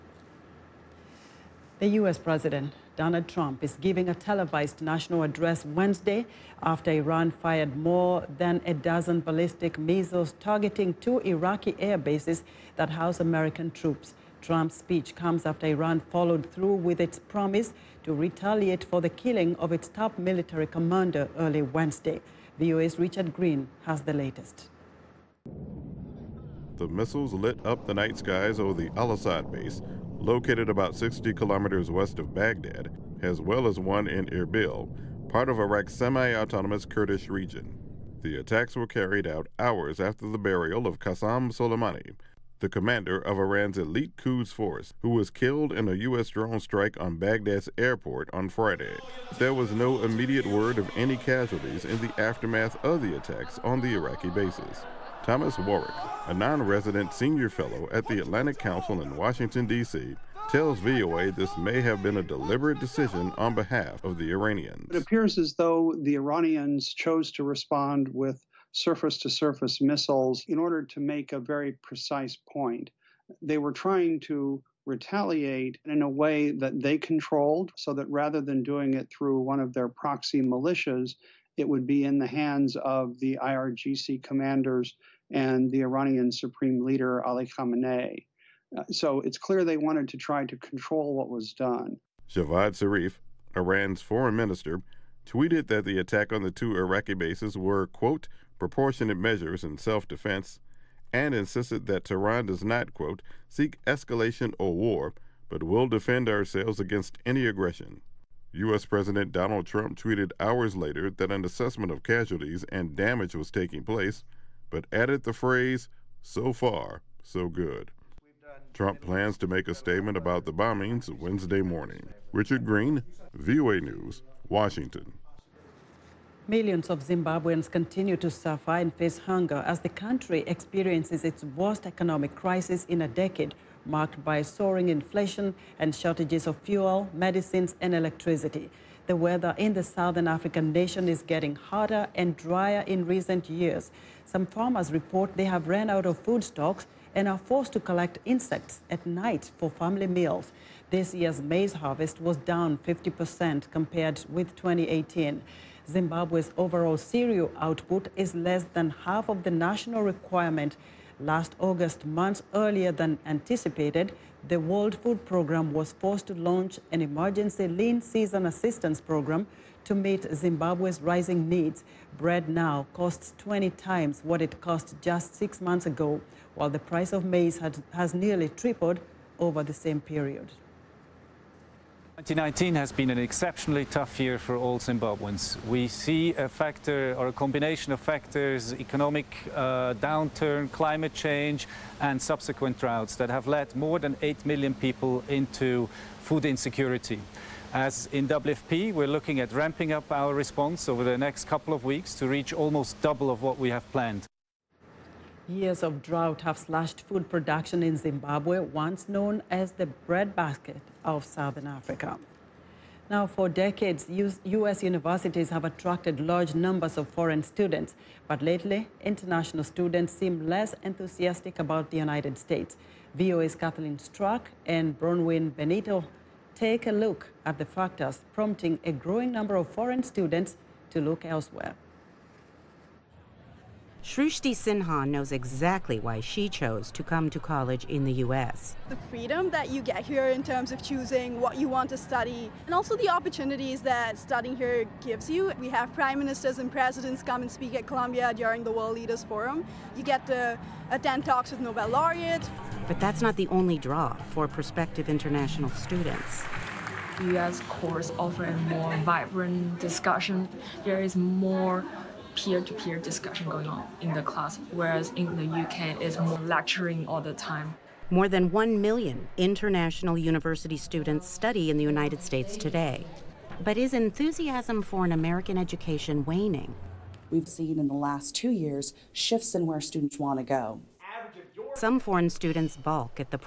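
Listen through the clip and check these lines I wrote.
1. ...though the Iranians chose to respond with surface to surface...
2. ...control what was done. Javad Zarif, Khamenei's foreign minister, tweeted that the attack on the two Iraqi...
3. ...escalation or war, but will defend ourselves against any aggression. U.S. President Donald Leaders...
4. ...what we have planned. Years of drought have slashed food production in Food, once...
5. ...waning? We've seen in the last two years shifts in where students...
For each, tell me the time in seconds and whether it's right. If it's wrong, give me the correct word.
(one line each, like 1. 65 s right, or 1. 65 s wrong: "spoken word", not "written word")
1. 65 s right
2. 90 s wrong: "Iran", not "Khamenei"
3. 103 s wrong: "Trump", not "Leaders"
4. 203 s wrong: "Zimbabwe", not "Food"
5. 276 s right.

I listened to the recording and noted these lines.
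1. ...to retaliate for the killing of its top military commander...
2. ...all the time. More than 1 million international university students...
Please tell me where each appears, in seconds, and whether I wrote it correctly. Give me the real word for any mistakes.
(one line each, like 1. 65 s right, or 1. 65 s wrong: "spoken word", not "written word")
1. 18 s right
2. 267 s right.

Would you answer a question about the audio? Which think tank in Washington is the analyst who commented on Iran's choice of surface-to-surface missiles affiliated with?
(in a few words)
Atlantic Council.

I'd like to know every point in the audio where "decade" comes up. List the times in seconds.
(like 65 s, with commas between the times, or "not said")
133 s, 213 s.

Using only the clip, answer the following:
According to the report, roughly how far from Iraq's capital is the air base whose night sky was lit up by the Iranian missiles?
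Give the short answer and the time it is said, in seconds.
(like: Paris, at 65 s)
60 kilometers, at 30 s.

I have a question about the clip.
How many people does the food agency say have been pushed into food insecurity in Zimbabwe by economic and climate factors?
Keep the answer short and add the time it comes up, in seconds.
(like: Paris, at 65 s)
More than 8 million, at 193 s.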